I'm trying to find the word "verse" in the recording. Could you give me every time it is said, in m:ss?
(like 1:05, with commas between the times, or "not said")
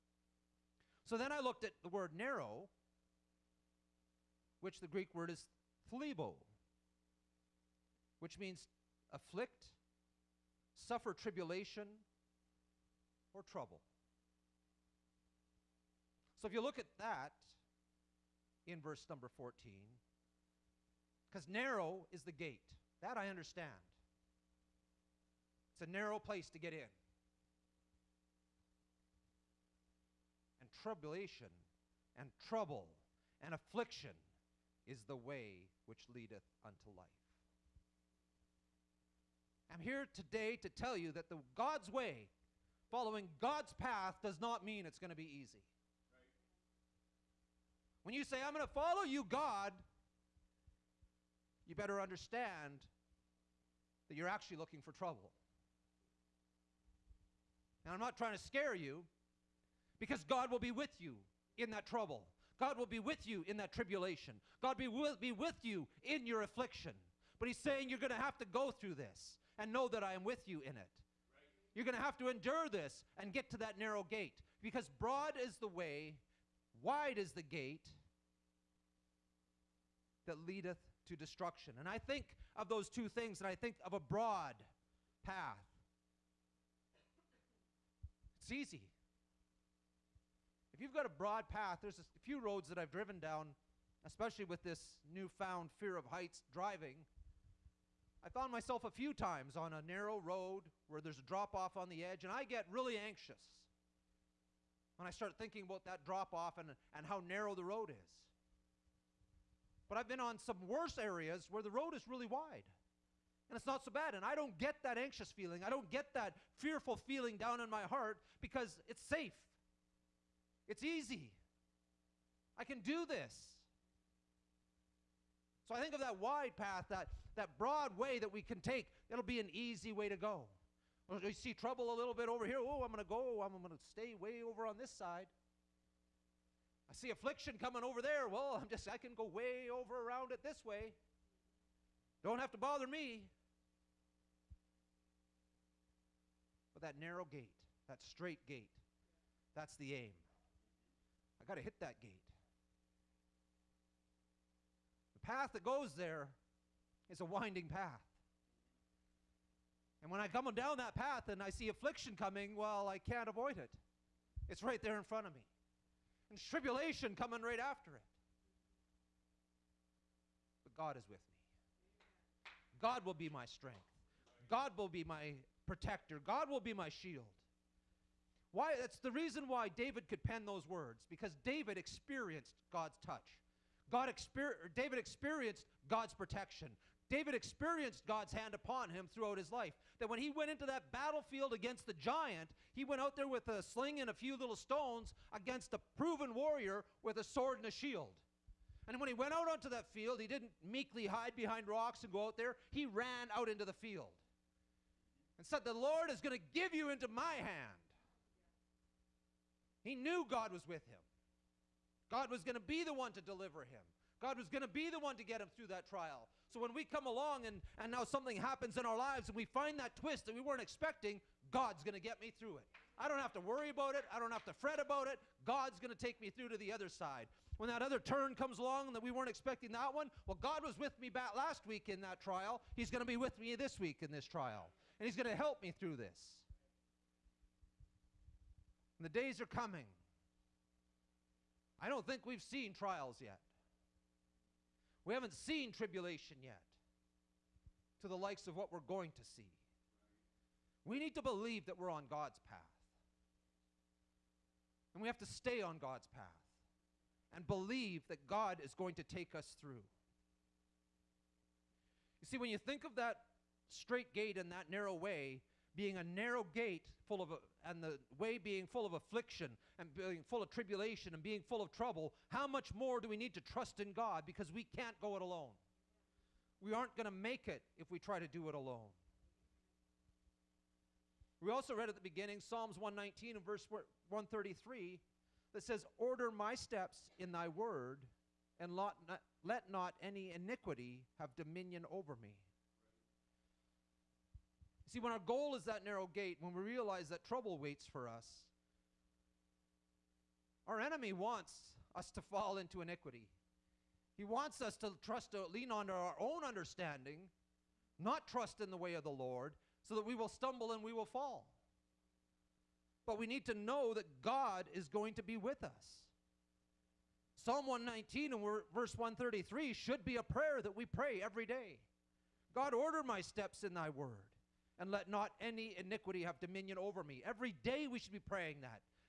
0:18, 4:43, 5:18.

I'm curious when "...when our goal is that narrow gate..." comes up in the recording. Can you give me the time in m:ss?
4:54.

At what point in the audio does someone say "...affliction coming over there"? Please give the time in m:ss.
2:17.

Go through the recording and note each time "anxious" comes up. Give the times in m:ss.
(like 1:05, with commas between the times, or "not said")
1:42, 1:54.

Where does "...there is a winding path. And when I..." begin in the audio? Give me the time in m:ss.
2:35.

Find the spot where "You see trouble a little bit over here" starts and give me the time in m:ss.
2:11.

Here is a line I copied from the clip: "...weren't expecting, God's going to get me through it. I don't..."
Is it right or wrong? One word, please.
right.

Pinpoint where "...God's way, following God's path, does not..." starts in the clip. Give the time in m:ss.
0:41.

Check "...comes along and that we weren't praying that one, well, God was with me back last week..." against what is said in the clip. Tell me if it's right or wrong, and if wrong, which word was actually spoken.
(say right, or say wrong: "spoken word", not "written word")
wrong: "expecting", not "praying".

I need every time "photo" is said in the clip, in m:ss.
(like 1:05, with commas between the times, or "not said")
not said.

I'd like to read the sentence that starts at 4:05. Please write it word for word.
We haven't seen tribulation yet to the likes of what we're going to see.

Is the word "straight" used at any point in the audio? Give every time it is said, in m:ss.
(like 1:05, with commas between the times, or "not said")
2:28, 4:23.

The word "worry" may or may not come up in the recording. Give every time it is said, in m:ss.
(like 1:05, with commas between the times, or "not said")
3:43.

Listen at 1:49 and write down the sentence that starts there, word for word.
But I've been on some worse areas where the road is really wide and it's not so bad.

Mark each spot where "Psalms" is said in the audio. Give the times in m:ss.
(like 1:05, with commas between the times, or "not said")
4:42, 5:17.